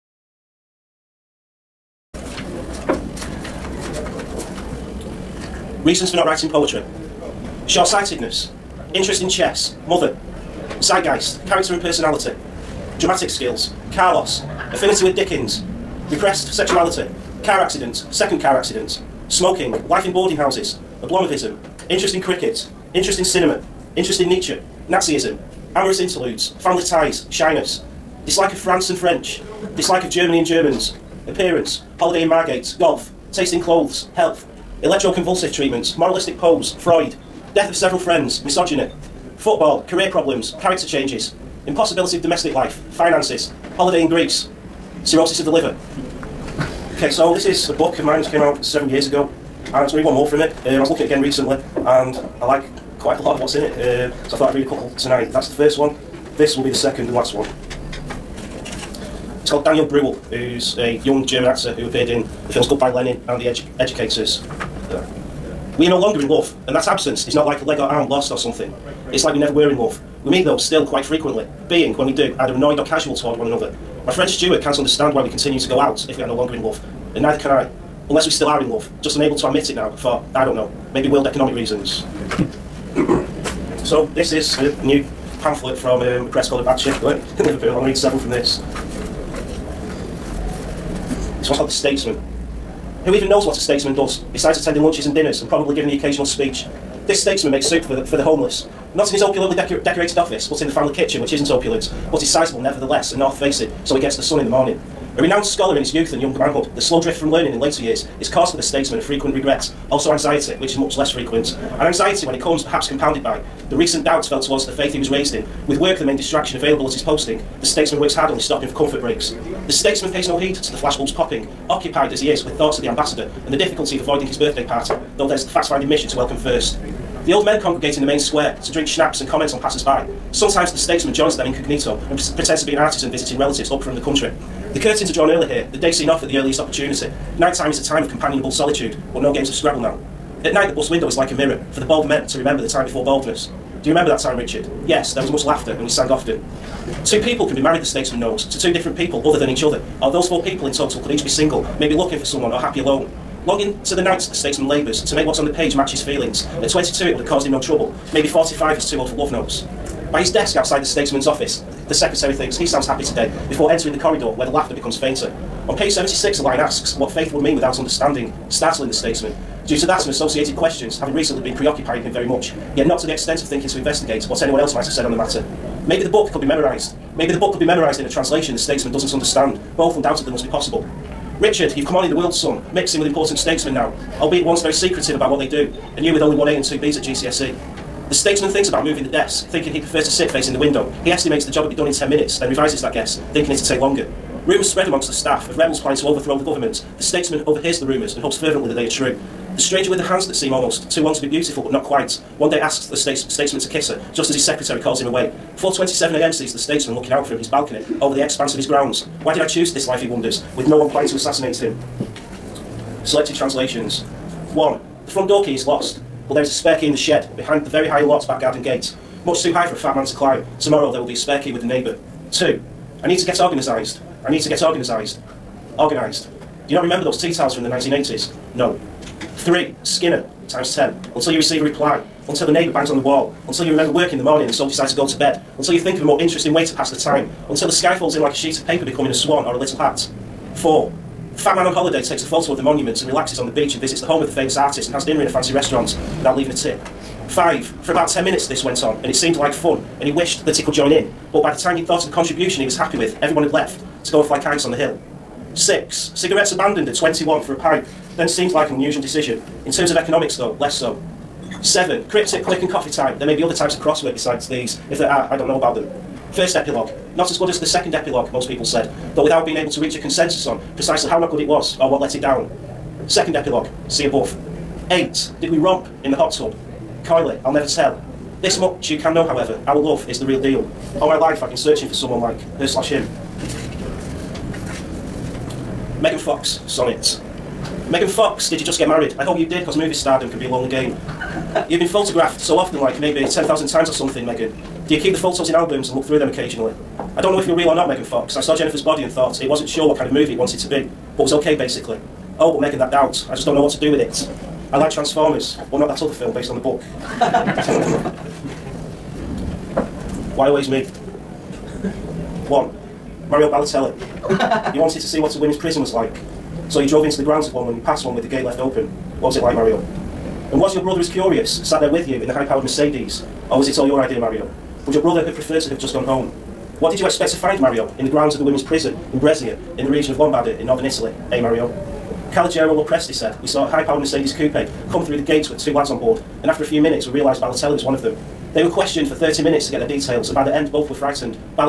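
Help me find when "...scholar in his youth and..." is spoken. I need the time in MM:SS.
01:45.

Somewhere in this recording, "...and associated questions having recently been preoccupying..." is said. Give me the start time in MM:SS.
02:50.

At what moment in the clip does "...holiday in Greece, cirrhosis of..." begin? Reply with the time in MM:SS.
00:43.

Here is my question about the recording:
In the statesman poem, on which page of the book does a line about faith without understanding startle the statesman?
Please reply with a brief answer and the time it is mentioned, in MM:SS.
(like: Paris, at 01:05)
76, at 02:45.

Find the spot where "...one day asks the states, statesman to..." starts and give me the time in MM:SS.
03:22.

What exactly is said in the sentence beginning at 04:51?
You've been photographed so often, like maybe 10,000 times or something, Megan.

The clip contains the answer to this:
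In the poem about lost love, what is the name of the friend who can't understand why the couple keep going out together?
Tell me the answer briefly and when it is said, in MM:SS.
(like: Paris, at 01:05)
Stuart, at 01:14.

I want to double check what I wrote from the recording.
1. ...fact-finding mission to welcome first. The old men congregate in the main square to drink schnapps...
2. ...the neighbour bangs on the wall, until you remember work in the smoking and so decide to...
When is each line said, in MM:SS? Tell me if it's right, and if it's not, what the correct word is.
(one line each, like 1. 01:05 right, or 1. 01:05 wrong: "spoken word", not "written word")
1. 02:05 right
2. 03:52 wrong: "morning", not "smoking".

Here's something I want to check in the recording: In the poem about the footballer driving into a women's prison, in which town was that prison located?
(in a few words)
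Brescia.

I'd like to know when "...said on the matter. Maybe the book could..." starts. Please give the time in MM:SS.
02:54.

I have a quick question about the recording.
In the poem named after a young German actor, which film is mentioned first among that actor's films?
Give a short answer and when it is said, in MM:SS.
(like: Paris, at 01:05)
Goodbye Lenin, at 01:02.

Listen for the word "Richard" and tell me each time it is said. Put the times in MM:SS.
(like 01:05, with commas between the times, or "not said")
02:24, 03:01.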